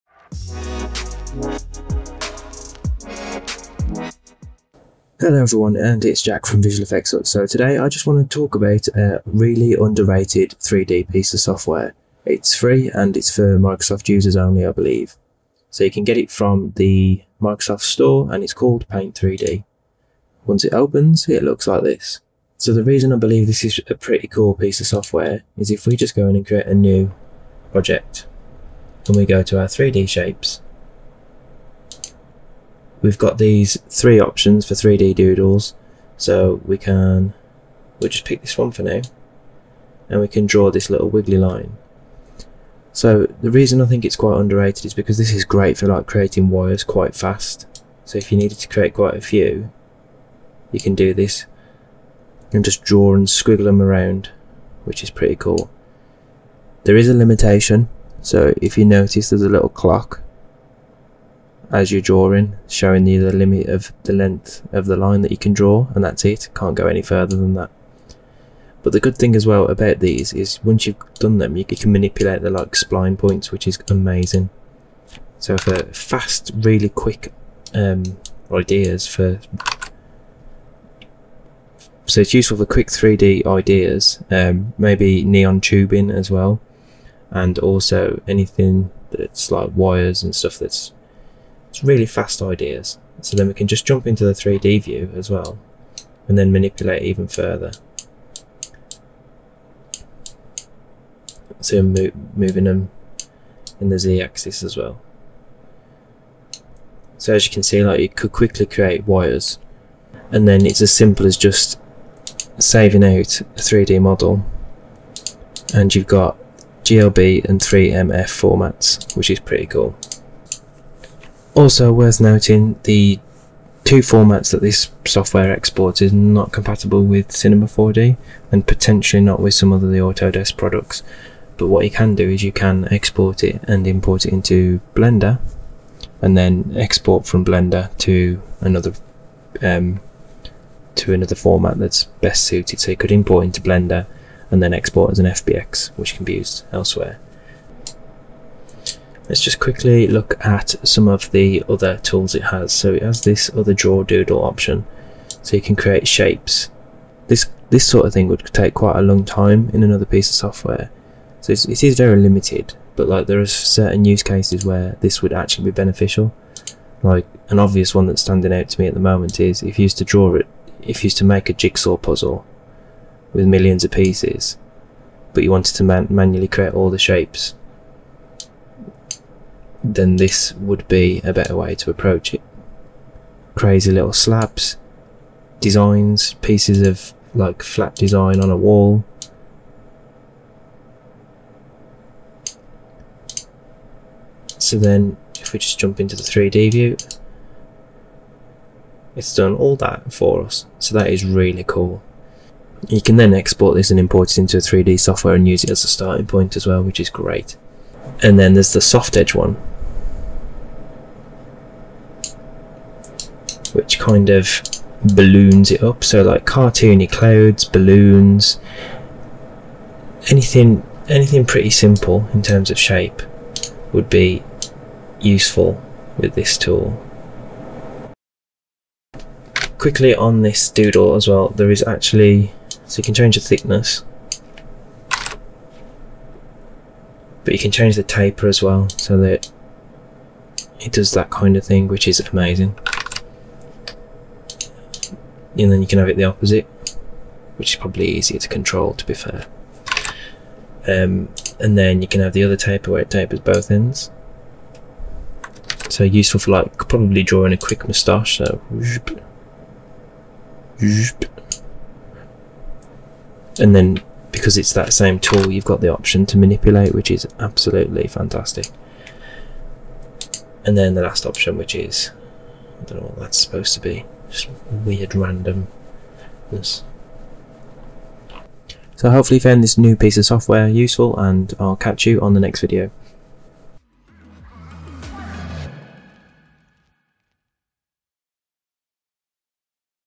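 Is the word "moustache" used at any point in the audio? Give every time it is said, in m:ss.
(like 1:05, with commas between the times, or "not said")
4:17.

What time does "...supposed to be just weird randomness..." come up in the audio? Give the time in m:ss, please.
4:33.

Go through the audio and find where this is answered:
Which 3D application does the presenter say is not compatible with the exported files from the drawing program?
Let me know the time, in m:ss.
2:07.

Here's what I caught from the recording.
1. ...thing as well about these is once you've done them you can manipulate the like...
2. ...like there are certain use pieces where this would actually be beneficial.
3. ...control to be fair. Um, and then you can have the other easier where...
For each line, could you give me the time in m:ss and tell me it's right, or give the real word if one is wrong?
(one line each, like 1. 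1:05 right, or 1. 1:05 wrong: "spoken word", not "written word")
1. 1:09 right
2. 2:43 wrong: "cases", not "pieces"
3. 4:08 wrong: "taper", not "easier".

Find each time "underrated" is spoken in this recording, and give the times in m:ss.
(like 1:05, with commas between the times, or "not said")
0:09, 0:44.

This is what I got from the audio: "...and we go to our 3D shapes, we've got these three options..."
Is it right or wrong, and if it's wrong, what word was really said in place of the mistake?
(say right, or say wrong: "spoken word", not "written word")
right.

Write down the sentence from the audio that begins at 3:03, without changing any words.
Crazy little slabs, designs, pieces of like flat design on a wall.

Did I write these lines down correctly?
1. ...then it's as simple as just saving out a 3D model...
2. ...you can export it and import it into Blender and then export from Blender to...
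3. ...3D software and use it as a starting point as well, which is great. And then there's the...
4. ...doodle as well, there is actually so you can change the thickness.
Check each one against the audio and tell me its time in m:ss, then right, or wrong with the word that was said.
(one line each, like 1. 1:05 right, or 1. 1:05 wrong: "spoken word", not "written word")
1. 1:50 right
2. 2:12 right
3. 3:24 right
4. 3:50 right.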